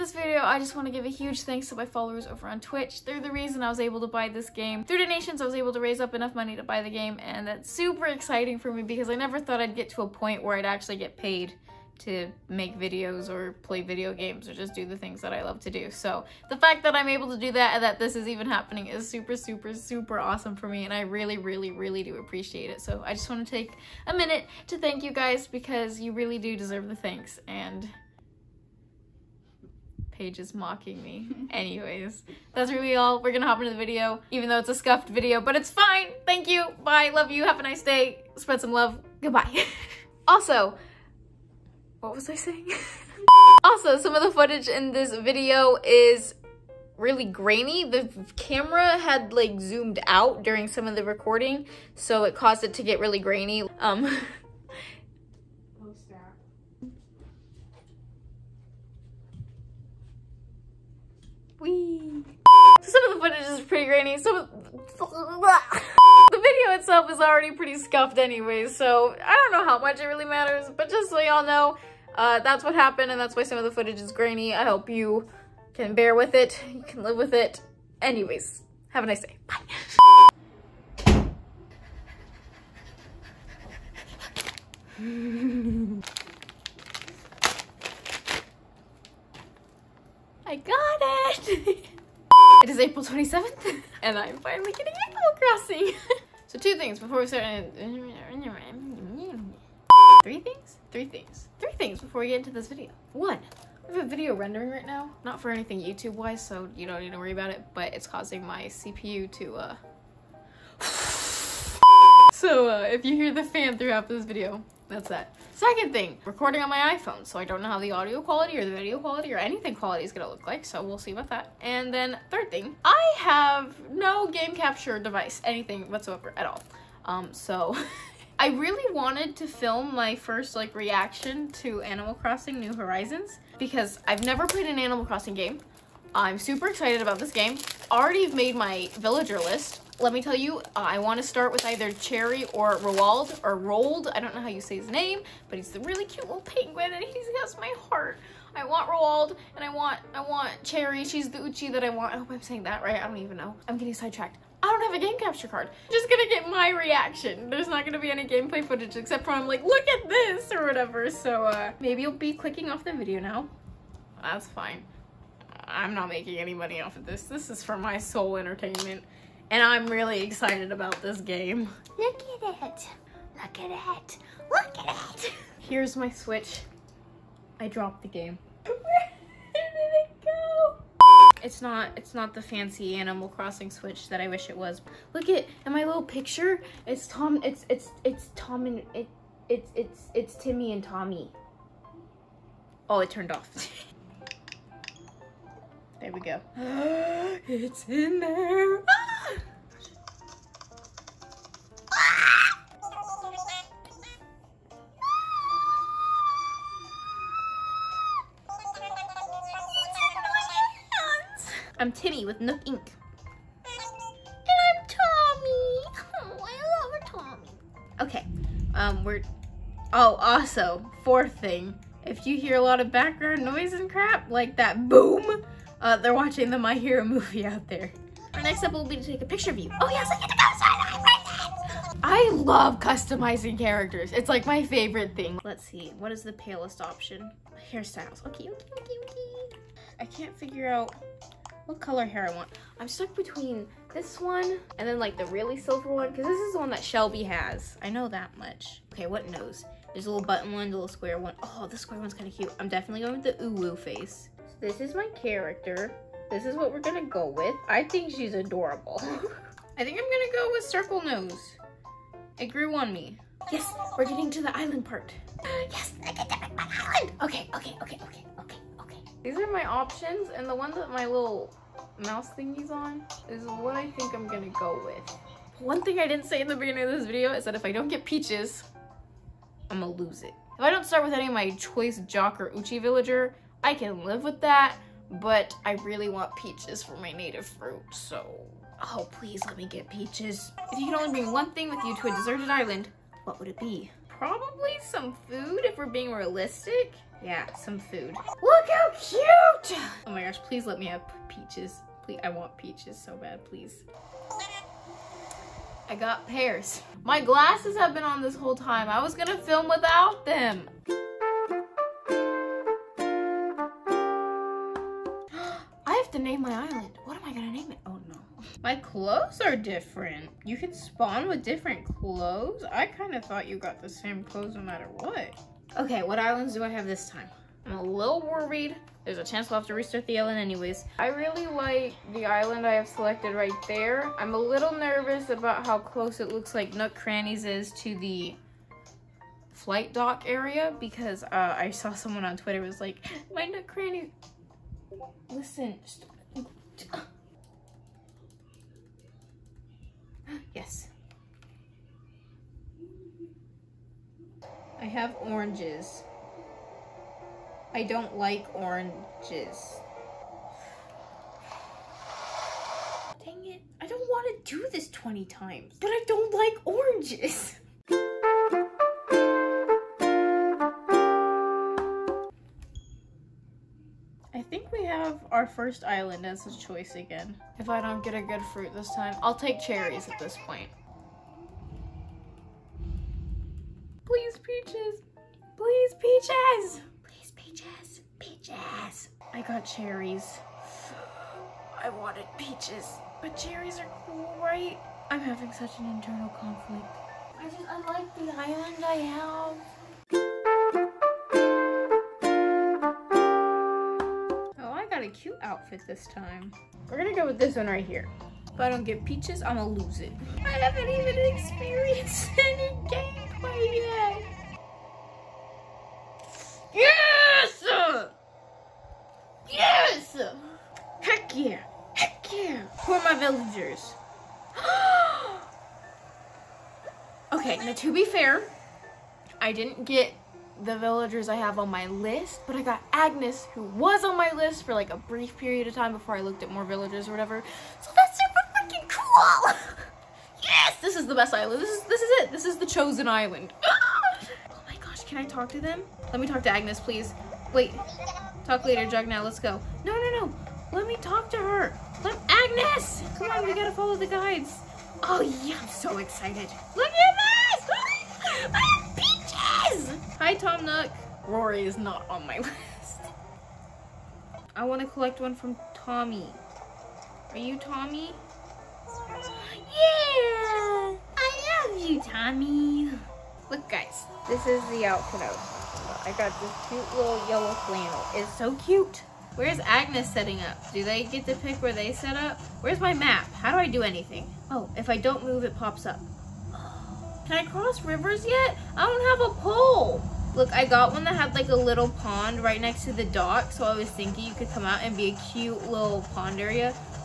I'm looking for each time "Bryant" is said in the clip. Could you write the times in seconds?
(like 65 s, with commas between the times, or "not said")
not said.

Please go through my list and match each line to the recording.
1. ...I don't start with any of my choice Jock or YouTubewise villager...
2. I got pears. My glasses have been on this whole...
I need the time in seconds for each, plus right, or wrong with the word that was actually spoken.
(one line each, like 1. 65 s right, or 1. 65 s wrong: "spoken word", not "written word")
1. 280 s wrong: "Uchi", not "YouTubewise"
2. 305 s right.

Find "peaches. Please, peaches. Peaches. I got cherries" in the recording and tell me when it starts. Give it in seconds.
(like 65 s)
386 s.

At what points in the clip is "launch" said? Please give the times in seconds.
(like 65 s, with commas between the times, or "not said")
not said.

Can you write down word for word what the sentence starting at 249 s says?
There's a little button one, a little square one.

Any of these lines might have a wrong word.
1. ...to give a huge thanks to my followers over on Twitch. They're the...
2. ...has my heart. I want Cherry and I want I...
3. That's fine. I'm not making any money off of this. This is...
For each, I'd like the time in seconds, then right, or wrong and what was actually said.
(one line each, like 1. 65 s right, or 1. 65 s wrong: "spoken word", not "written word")
1. 0 s right
2. 147 s wrong: "Roald", not "Cherry"
3. 164 s right.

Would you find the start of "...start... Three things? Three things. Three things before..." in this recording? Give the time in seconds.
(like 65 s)
97 s.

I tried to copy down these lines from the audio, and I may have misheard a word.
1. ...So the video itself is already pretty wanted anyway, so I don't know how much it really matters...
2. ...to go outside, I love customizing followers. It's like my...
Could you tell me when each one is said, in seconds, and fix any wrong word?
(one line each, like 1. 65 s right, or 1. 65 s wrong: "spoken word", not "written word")
1. 64 s wrong: "scuffed", not "wanted"
2. 230 s wrong: "characters", not "followers".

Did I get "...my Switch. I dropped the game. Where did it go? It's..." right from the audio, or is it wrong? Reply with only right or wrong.
right.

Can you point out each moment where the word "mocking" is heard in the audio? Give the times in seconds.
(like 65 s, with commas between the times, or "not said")
30 s.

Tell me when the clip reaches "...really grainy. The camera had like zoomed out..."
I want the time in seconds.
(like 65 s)
46 s.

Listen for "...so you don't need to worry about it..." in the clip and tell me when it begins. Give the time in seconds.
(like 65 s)
106 s.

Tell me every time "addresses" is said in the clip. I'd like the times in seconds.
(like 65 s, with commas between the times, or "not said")
not said.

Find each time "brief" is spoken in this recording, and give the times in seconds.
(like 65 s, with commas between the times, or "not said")
434 s.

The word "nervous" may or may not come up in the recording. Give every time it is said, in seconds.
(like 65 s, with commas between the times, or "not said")
334 s.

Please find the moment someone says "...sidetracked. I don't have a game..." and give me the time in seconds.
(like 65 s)
153 s.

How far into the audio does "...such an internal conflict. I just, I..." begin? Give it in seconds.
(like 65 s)
395 s.